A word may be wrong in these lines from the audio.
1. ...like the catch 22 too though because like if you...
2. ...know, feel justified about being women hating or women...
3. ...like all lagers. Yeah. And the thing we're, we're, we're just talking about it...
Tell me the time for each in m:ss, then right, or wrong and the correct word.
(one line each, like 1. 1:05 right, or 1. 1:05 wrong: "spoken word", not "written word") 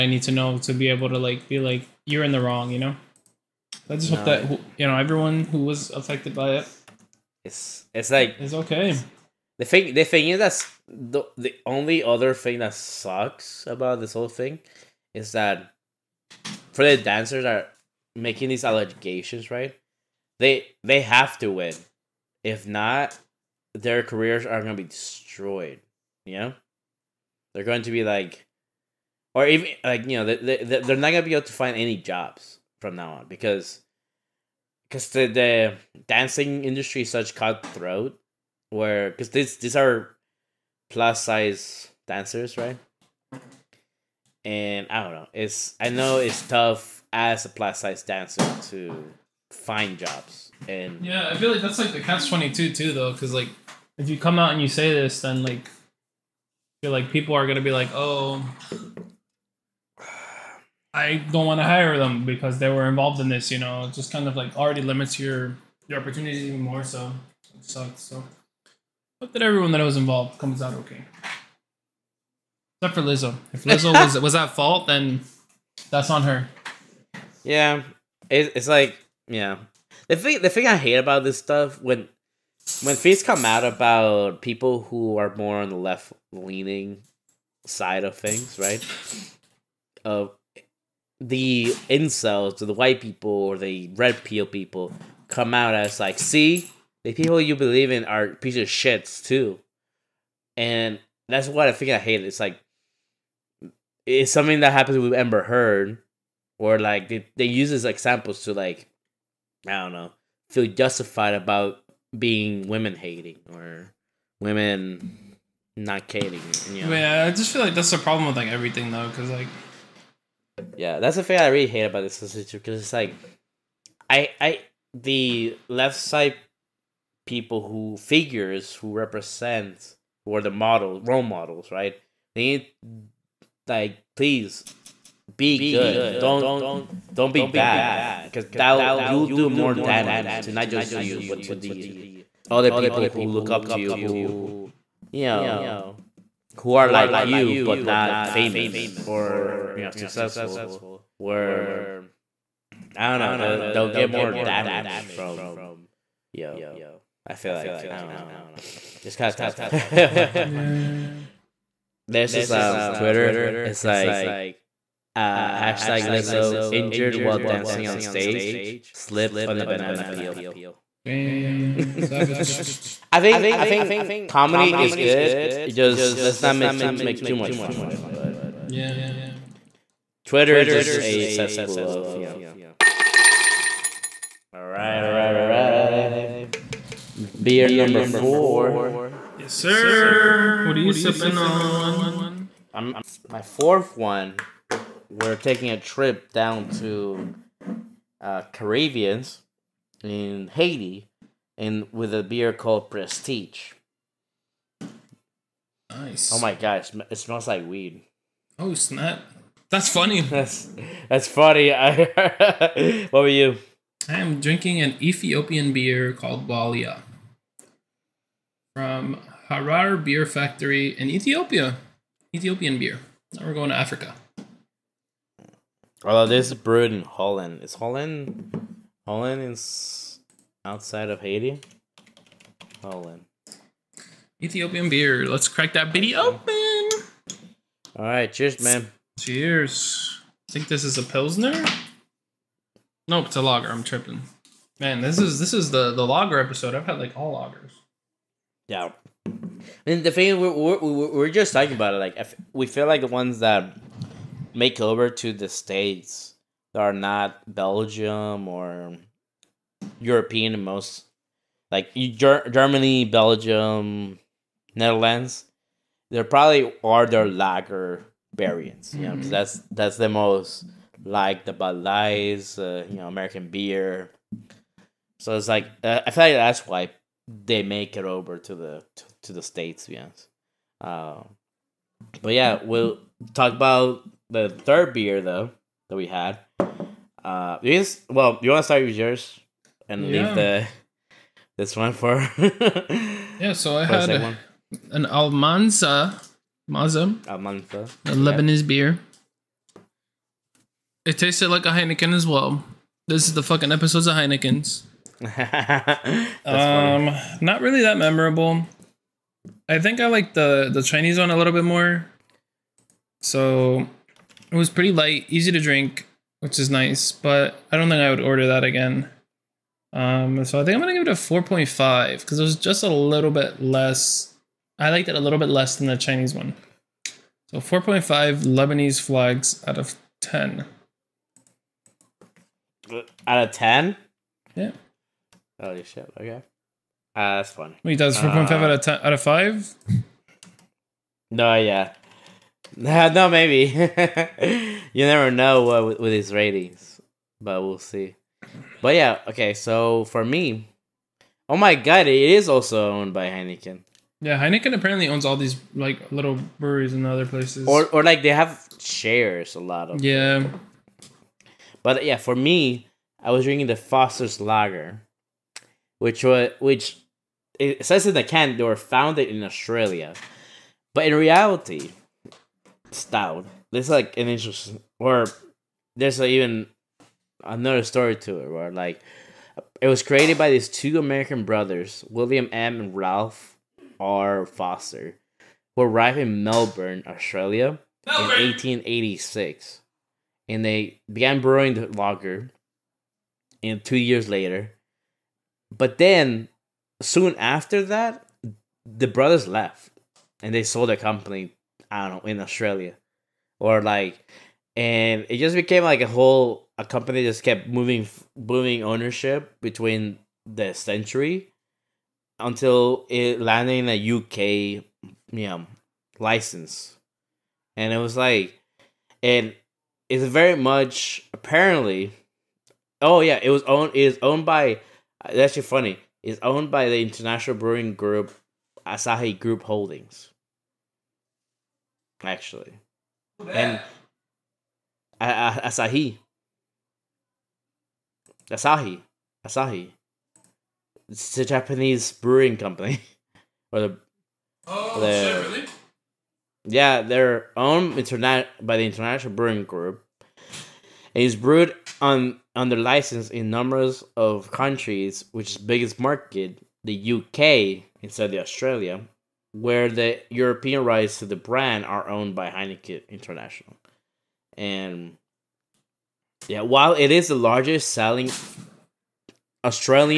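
1. 0:51 right
2. 1:49 right
3. 4:07 right.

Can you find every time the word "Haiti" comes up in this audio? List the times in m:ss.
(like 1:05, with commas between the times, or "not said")
3:20, 3:51.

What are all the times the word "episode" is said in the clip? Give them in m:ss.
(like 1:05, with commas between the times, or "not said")
4:06, 5:03.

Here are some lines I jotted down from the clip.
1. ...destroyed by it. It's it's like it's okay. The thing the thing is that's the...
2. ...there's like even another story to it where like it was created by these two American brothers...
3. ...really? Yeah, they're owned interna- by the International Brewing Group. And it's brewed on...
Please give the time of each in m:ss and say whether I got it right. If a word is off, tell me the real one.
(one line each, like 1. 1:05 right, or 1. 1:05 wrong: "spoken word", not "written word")
1. 0:05 wrong: "affected", not "destroyed"
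2. 6:15 right
3. 7:25 right.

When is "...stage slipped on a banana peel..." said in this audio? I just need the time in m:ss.
2:48.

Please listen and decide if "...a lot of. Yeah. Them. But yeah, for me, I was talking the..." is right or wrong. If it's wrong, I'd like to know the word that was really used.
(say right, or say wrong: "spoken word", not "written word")
wrong: "drinking", not "talking".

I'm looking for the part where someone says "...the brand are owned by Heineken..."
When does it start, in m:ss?
7:41.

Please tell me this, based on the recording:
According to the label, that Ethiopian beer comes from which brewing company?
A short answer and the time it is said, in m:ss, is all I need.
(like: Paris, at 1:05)
Harar Beer Factory, at 3:39.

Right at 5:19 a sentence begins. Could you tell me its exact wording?
Um, so I think I'm gonna give it a 4.5 because it was just a little bit less.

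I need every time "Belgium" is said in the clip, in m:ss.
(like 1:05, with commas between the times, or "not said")
4:17, 4:23.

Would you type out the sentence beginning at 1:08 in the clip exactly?
So hope that everyone that was involved comes out okay.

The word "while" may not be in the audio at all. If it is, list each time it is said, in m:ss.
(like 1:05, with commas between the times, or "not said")
2:47, 7:46.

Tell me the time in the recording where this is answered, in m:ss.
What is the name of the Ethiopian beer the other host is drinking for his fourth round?
3:36.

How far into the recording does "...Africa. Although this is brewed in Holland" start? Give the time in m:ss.
3:43.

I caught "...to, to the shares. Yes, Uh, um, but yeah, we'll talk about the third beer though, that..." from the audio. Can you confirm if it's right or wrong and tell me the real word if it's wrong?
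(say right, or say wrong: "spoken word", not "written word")
wrong: "states", not "shares".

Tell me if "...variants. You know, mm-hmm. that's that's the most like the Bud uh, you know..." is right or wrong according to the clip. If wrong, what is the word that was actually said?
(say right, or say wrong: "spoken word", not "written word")
right.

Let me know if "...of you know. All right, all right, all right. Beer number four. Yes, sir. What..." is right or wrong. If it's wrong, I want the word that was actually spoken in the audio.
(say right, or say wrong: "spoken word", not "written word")
right.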